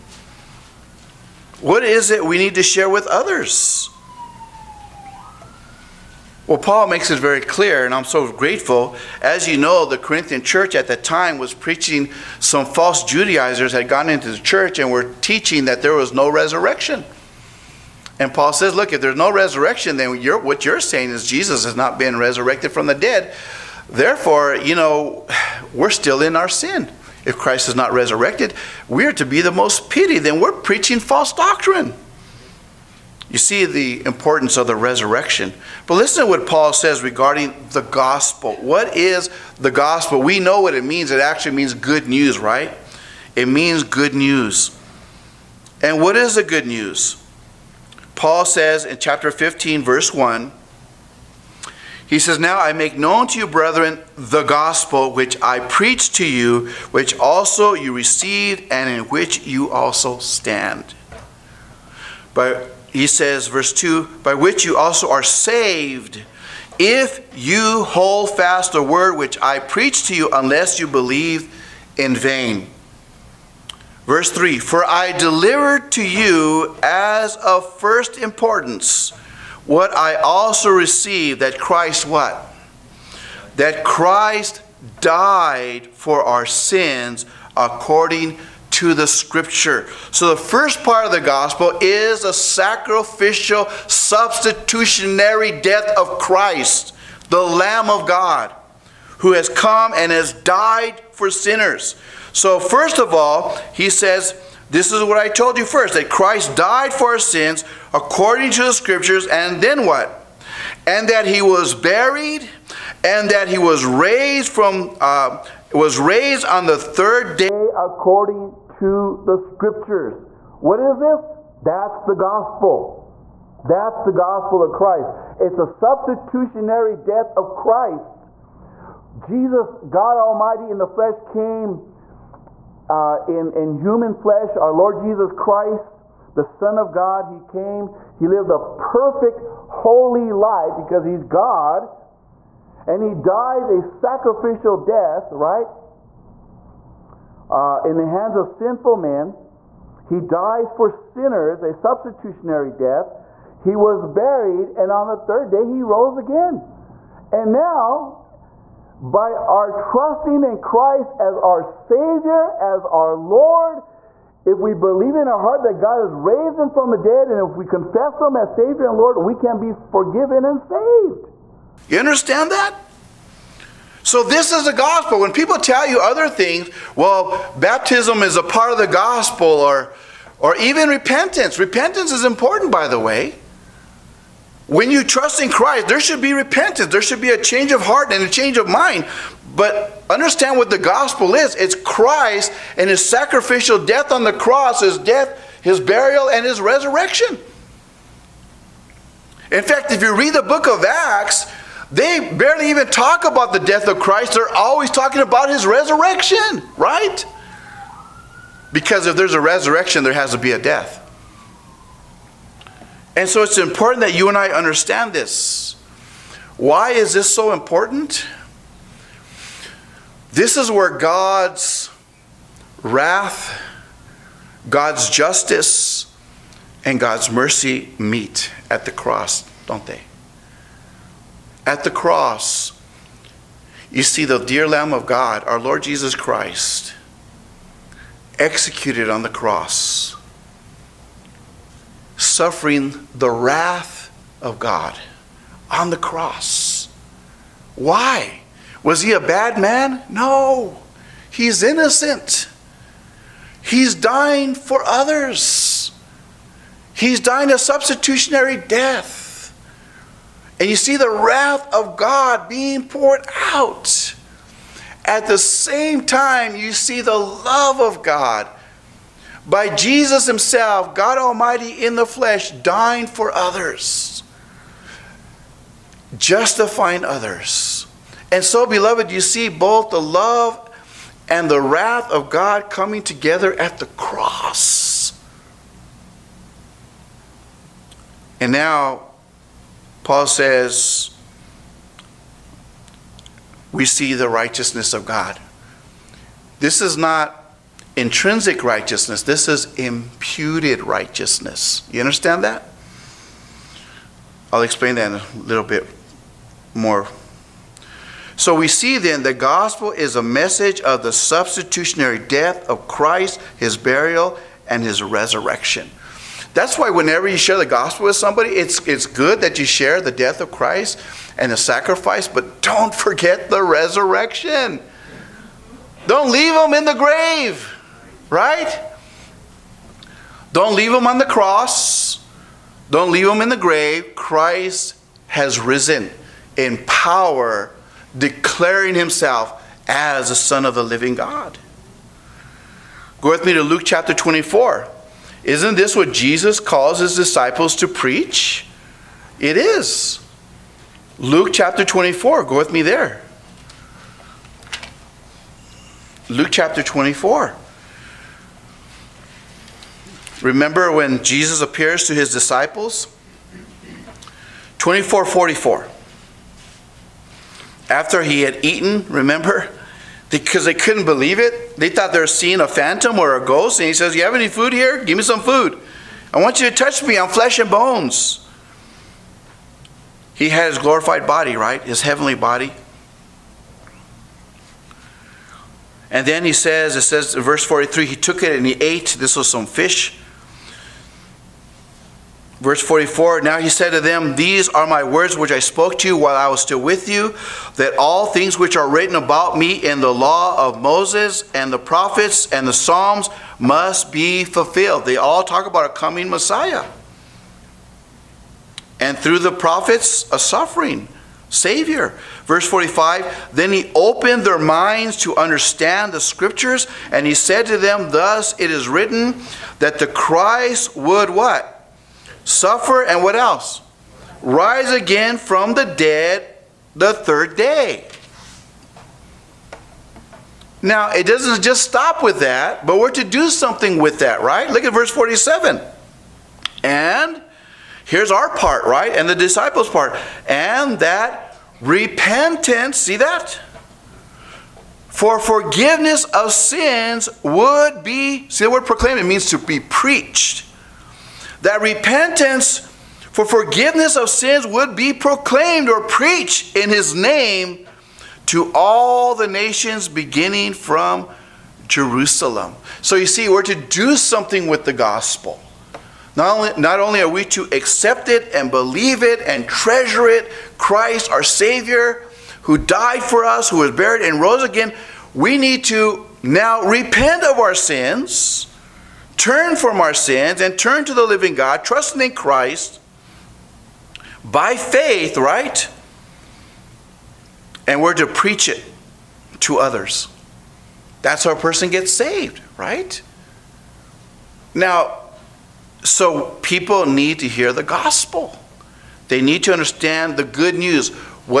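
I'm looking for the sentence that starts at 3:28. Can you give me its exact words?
Because if there's a resurrection, there has to be a death.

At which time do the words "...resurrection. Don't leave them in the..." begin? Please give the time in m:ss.
5:23.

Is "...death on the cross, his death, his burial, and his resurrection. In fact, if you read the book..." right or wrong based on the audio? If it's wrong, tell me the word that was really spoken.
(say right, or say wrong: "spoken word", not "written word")
right.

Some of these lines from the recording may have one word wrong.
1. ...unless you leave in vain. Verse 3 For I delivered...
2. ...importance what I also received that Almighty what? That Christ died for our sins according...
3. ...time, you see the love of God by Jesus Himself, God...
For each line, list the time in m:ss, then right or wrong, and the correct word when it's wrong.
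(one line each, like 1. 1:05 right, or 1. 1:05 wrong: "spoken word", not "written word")
1. 1:10 wrong: "believe", not "leave"
2. 1:18 wrong: "Christ", not "Almighty"
3. 4:26 right.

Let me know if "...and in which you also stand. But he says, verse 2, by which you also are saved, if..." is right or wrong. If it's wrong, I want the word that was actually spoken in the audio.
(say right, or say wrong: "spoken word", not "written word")
right.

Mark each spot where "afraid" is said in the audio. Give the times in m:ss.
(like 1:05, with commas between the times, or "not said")
not said.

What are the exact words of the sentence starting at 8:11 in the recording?
That's how a person gets saved, right?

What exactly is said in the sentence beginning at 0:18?
And Paul says, look, if there's no resurrection, then you're, what you're saying is Jesus has not been resurrected from the dead.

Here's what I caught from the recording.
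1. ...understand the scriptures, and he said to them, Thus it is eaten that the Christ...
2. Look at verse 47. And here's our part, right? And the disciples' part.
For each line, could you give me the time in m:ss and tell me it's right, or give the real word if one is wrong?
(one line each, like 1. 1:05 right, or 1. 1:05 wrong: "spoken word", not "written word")
1. 6:55 wrong: "written", not "eaten"
2. 7:14 right.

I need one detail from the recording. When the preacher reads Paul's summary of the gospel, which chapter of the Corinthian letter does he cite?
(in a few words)
Chapter 15.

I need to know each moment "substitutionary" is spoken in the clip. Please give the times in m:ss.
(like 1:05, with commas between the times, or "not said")
1:33, 2:05, 2:31, 4:17, 5:11.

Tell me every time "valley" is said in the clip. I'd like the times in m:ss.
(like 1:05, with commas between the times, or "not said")
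not said.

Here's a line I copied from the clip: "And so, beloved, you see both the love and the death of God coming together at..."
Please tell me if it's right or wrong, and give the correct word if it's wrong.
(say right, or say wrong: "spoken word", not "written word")
wrong: "wrath", not "death".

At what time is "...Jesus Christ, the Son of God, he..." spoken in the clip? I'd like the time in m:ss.
2:14.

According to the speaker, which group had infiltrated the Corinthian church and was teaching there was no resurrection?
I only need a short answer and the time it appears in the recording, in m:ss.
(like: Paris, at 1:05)
Judaizers, at 0:13.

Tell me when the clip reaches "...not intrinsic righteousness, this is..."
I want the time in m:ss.
4:56.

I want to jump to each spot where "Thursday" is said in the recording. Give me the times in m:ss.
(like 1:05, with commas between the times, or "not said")
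not said.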